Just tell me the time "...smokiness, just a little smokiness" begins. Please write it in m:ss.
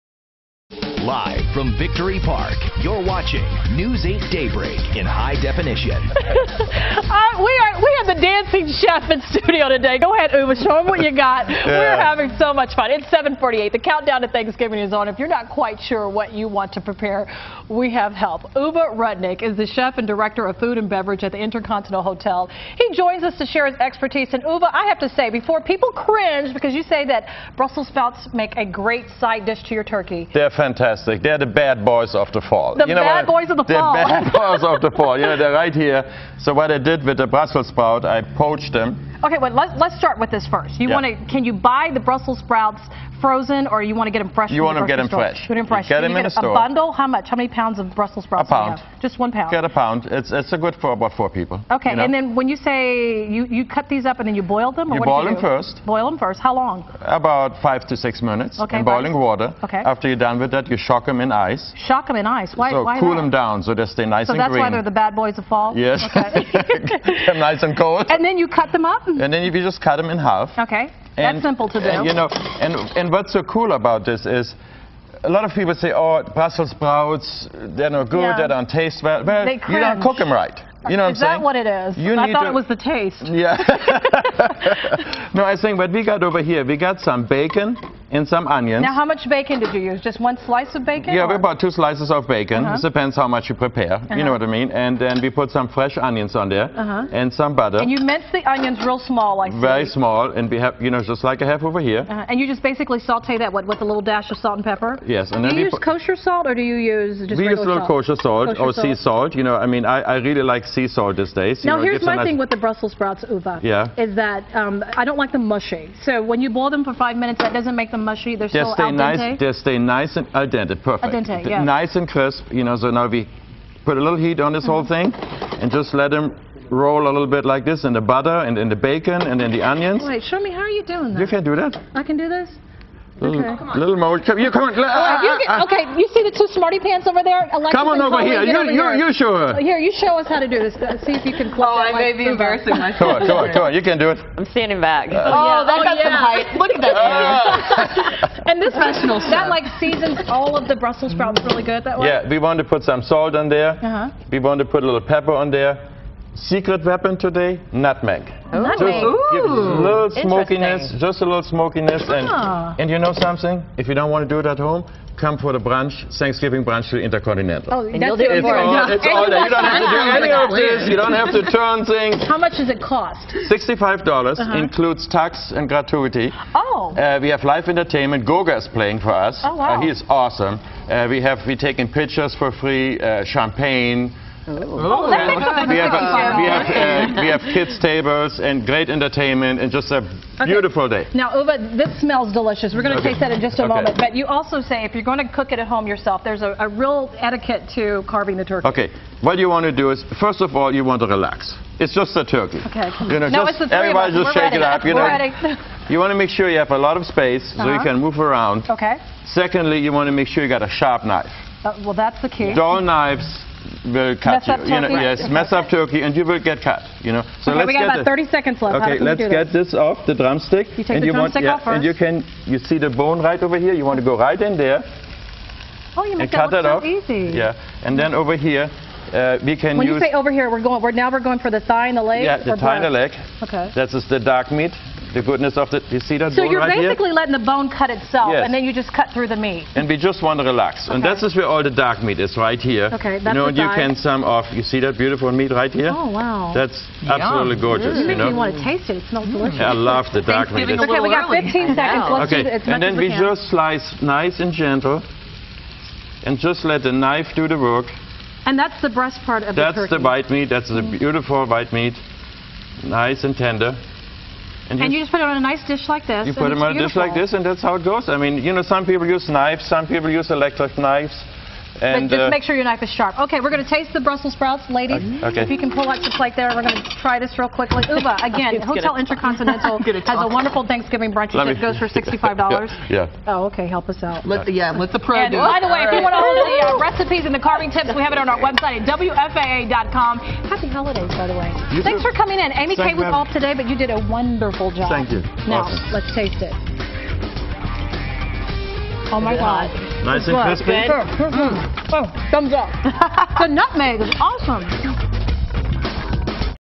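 2:40.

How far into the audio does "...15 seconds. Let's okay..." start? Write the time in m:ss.
4:11.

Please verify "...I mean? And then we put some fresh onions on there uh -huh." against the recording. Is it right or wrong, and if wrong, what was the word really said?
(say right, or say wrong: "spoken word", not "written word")
right.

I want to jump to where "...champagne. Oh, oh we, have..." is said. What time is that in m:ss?
3:03.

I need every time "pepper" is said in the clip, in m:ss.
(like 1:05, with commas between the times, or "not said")
1:44, 2:35.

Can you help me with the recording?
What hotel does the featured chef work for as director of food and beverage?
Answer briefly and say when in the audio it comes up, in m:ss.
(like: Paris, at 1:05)
Intercontinental Hotel, at 0:21.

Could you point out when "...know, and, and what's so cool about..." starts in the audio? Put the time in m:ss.
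1:12.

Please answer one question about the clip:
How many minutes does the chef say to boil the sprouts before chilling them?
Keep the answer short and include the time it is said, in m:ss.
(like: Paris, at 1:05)
5 to 6 minutes, at 0:57.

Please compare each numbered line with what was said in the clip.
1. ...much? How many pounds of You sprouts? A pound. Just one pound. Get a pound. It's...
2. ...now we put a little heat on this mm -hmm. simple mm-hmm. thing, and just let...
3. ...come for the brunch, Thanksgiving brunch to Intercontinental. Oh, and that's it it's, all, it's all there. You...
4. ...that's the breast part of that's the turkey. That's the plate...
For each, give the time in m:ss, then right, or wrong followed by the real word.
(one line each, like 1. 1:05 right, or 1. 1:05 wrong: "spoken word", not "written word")
1. 0:47 wrong: "Brussels", not "You"
2. 2:02 wrong: "whole", not "simple"
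3. 2:45 right
4. 4:18 wrong: "white", not "plate".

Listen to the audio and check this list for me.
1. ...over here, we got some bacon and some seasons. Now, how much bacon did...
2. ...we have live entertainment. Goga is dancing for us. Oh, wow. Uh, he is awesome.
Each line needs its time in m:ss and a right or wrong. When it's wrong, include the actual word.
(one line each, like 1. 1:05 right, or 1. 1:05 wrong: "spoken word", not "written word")
1. 1:26 wrong: "onions", not "seasons"
2. 2:57 wrong: "playing", not "dancing".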